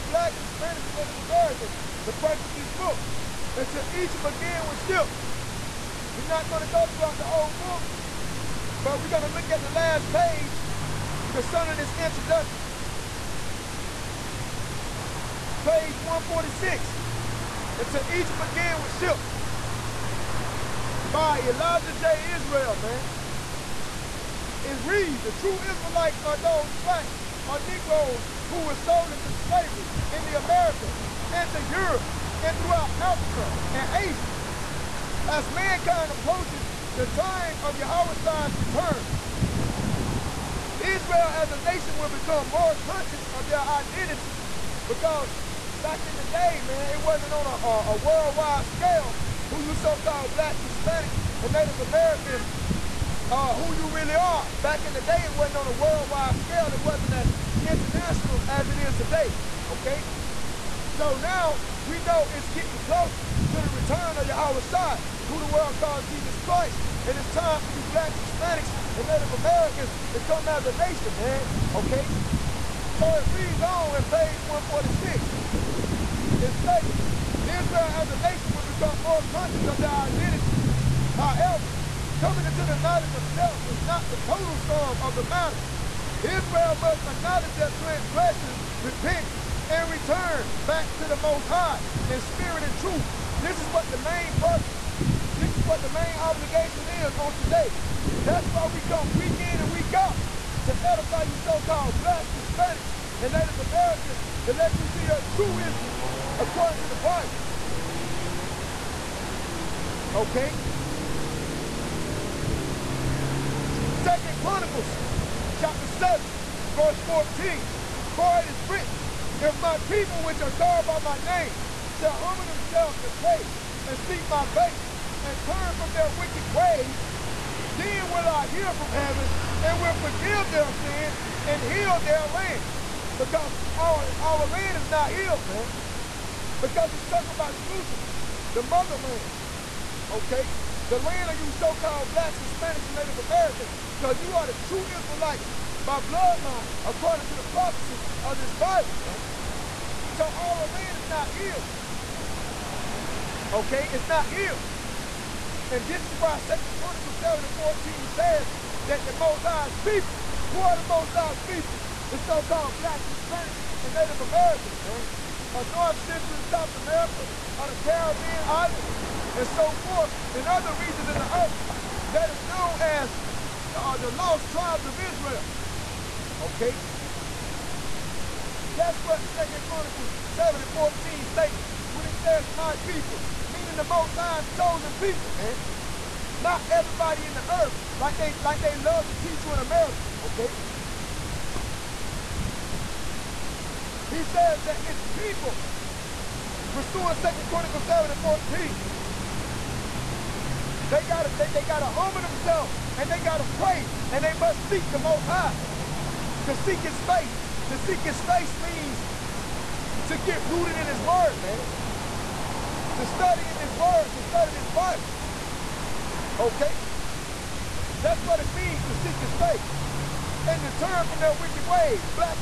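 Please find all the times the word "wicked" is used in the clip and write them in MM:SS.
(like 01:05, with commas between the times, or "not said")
02:06, 03:41.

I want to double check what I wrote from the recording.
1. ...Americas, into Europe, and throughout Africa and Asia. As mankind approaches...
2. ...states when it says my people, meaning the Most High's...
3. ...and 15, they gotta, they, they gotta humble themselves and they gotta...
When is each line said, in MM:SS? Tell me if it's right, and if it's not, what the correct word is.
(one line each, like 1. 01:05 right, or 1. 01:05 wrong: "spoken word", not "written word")
1. 00:30 right
2. 03:01 right
3. 03:18 wrong: "14", not "15".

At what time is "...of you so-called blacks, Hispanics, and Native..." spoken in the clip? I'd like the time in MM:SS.
02:21.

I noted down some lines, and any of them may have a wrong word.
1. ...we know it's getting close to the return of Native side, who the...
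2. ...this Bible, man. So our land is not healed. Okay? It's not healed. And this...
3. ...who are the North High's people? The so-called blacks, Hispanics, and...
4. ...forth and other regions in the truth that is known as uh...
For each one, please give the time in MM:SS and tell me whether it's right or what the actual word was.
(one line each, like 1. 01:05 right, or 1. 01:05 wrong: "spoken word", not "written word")
1. 01:01 wrong: "Yahweh", not "Native"
2. 02:28 right
3. 02:40 wrong: "Most", not "North"
4. 02:49 wrong: "earth", not "truth".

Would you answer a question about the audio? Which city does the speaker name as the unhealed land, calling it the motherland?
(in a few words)
Jerusalem.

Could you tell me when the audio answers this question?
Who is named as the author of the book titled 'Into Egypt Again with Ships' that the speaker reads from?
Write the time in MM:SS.
00:21.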